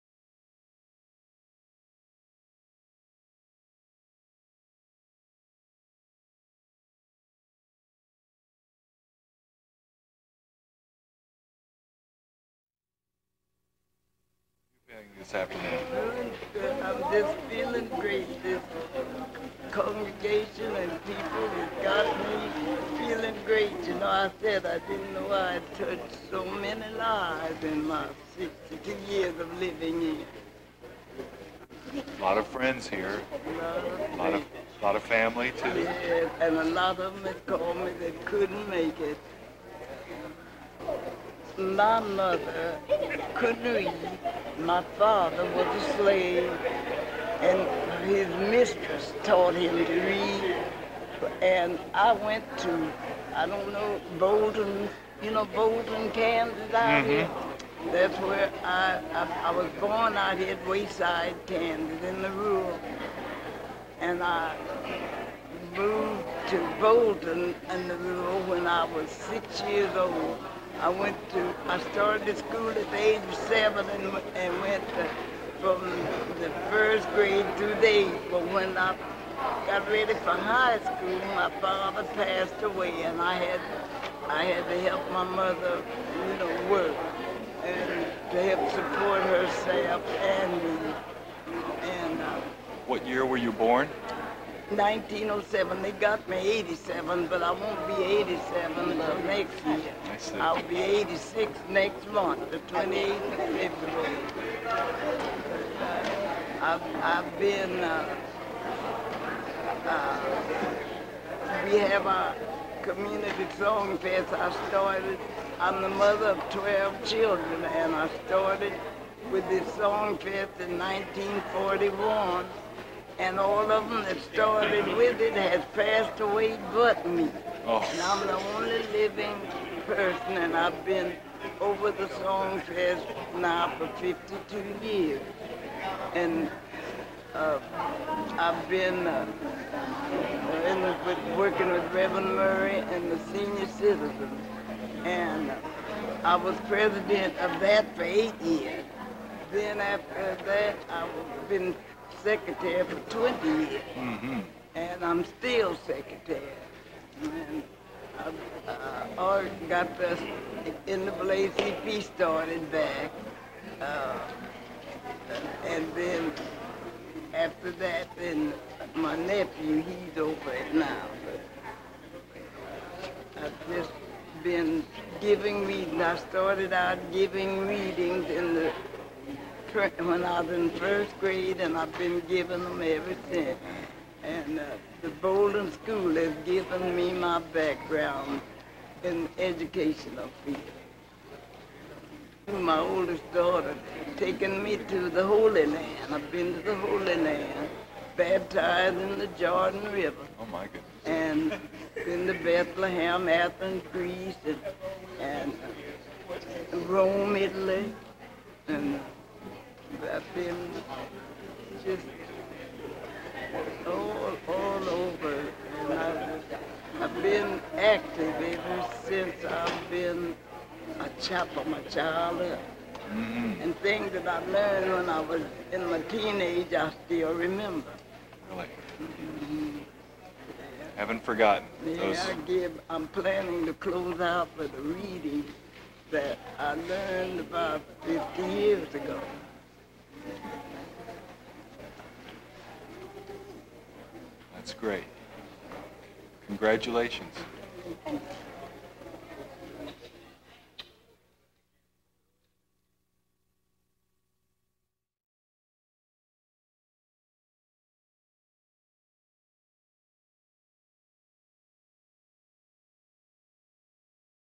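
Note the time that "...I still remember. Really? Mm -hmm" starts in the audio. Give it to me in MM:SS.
03:46.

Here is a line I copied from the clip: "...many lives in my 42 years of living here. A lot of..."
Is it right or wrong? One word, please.
wrong.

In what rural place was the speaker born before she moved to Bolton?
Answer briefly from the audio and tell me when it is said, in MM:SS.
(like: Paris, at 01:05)
Wayside, Kansas, at 01:00.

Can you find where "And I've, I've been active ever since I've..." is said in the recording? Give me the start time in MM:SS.
03:35.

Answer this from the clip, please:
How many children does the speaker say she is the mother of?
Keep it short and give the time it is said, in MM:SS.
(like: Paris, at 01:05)
12, at 01:56.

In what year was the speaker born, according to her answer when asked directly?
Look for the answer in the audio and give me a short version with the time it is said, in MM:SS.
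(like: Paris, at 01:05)
1907, at 01:34.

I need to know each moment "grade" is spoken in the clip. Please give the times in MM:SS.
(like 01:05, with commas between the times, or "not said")
01:17, 03:01.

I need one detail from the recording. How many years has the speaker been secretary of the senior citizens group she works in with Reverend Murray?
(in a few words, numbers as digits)
20.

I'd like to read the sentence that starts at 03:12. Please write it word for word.
My oldest daughter taken me to the Holy Land.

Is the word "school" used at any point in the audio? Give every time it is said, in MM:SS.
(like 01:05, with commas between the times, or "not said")
01:12, 01:20, 03:05.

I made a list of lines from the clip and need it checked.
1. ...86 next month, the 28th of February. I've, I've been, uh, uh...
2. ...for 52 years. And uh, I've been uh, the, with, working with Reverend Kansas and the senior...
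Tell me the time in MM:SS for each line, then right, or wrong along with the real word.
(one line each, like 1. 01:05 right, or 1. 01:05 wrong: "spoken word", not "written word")
1. 01:40 right
2. 02:13 wrong: "Murray", not "Kansas".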